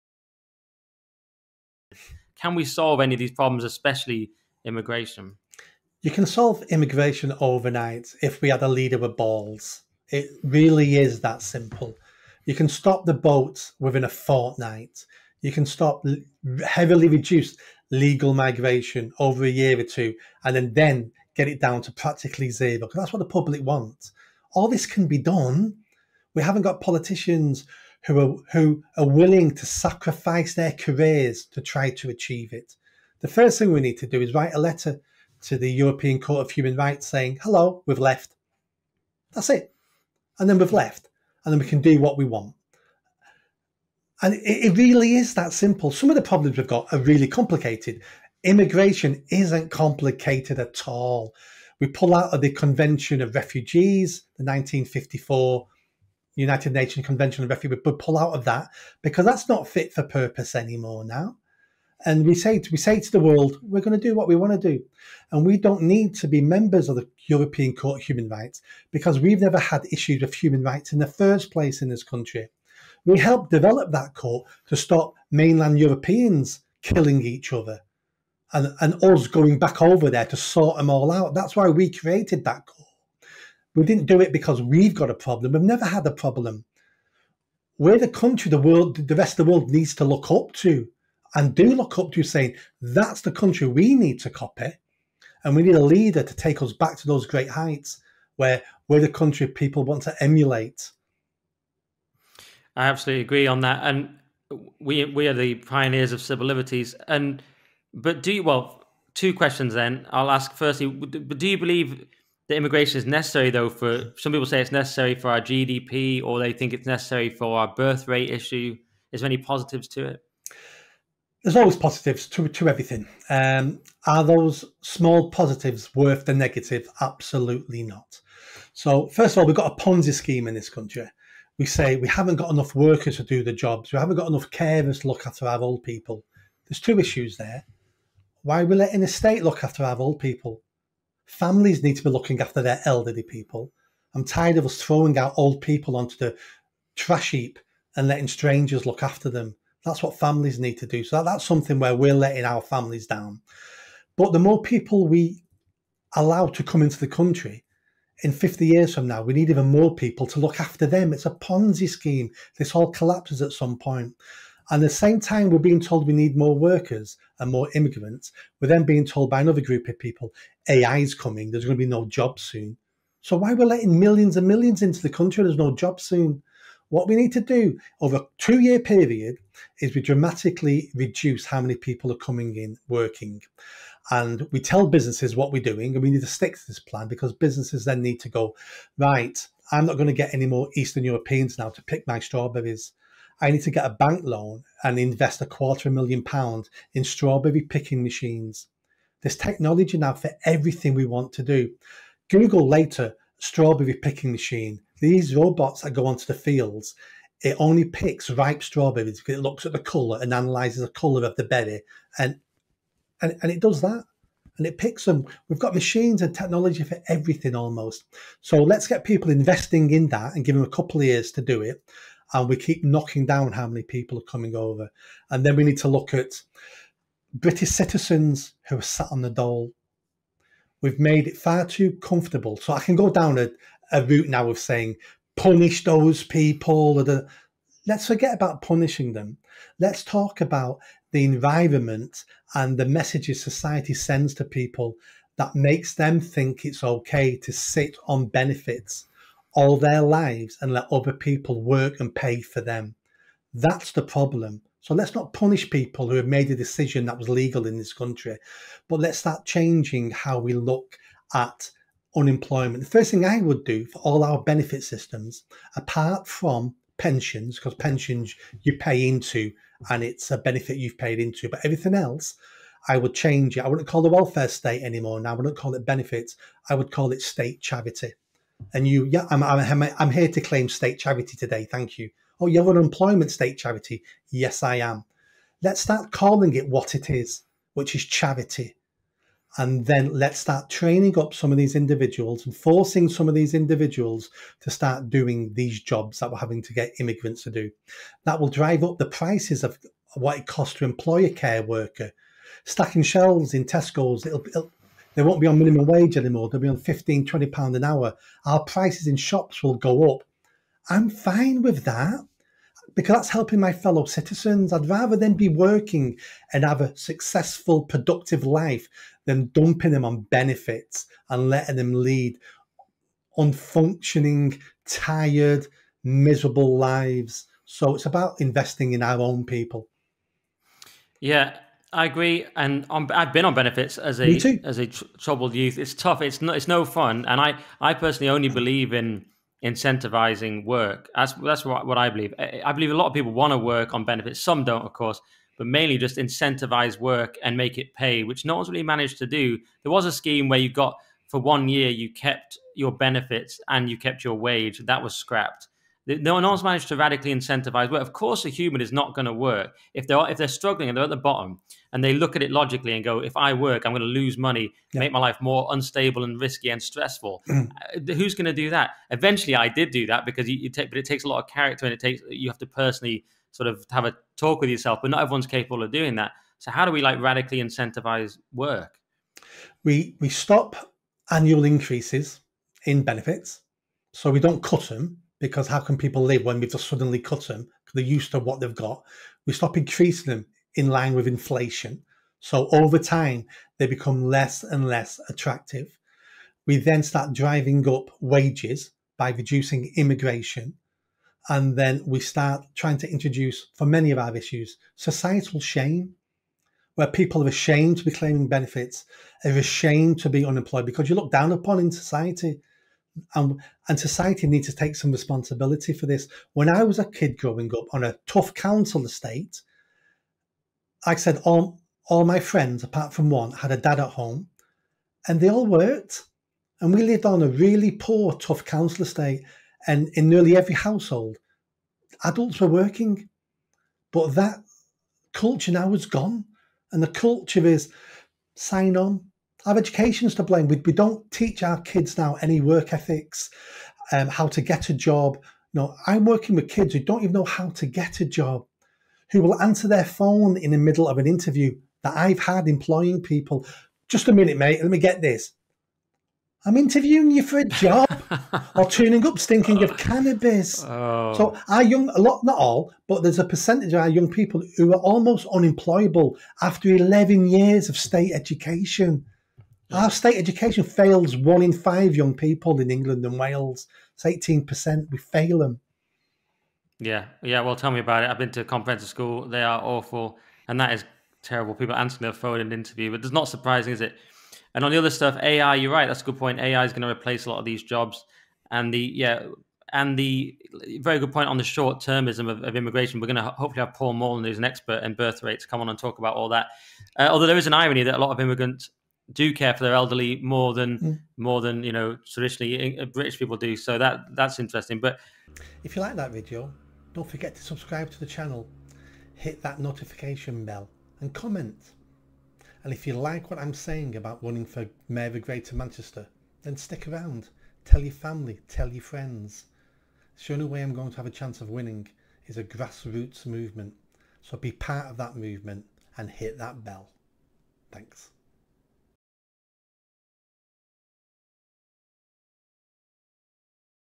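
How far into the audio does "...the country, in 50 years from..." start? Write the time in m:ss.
2:36.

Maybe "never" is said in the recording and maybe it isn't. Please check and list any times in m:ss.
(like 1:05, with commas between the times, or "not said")
1:09, 1:25.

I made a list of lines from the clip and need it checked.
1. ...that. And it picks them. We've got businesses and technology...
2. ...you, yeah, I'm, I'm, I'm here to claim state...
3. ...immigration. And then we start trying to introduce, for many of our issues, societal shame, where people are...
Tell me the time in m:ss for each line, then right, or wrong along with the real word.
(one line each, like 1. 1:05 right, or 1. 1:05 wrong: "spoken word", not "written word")
1. 3:33 wrong: "machines", not "businesses"
2. 4:38 right
3. 6:39 right.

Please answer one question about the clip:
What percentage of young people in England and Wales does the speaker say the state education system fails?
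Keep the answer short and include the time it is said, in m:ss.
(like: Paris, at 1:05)
18%, at 7:54.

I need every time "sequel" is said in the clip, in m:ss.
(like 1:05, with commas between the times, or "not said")
not said.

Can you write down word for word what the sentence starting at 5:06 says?
They'll be on 15, 20 pounds an hour.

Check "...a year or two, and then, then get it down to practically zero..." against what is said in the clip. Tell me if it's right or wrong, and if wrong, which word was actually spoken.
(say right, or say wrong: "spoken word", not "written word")
right.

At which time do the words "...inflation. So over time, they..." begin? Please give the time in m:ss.
6:31.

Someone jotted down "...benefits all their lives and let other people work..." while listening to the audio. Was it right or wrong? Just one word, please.
right.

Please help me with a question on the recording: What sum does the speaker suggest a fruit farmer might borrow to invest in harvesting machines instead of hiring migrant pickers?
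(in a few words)
A quarter of a million pounds.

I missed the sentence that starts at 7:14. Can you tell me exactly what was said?
But that culture now is gone, and the culture is sign on, our education's to blame.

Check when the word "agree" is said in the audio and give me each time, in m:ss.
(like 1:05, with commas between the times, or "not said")
1:43, 5:32.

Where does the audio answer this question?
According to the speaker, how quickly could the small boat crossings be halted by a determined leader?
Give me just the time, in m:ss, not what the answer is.
0:13.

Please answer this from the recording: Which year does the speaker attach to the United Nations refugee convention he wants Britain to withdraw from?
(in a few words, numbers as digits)
1954.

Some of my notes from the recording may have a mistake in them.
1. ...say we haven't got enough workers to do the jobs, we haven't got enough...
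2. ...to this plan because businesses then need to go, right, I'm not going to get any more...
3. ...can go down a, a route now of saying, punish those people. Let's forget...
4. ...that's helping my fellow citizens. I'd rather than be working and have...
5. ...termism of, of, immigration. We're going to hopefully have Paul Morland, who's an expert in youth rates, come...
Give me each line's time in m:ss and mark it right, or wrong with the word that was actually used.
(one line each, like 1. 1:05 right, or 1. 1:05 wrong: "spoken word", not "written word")
1. 2:11 right
2. 3:06 right
3. 3:52 right
4. 5:13 right
5. 8:11 wrong: "birth", not "youth".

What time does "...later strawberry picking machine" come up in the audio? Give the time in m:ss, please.
3:22.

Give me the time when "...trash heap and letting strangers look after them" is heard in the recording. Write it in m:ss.
2:26.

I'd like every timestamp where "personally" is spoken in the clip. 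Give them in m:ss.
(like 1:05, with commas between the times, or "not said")
5:37, 6:12.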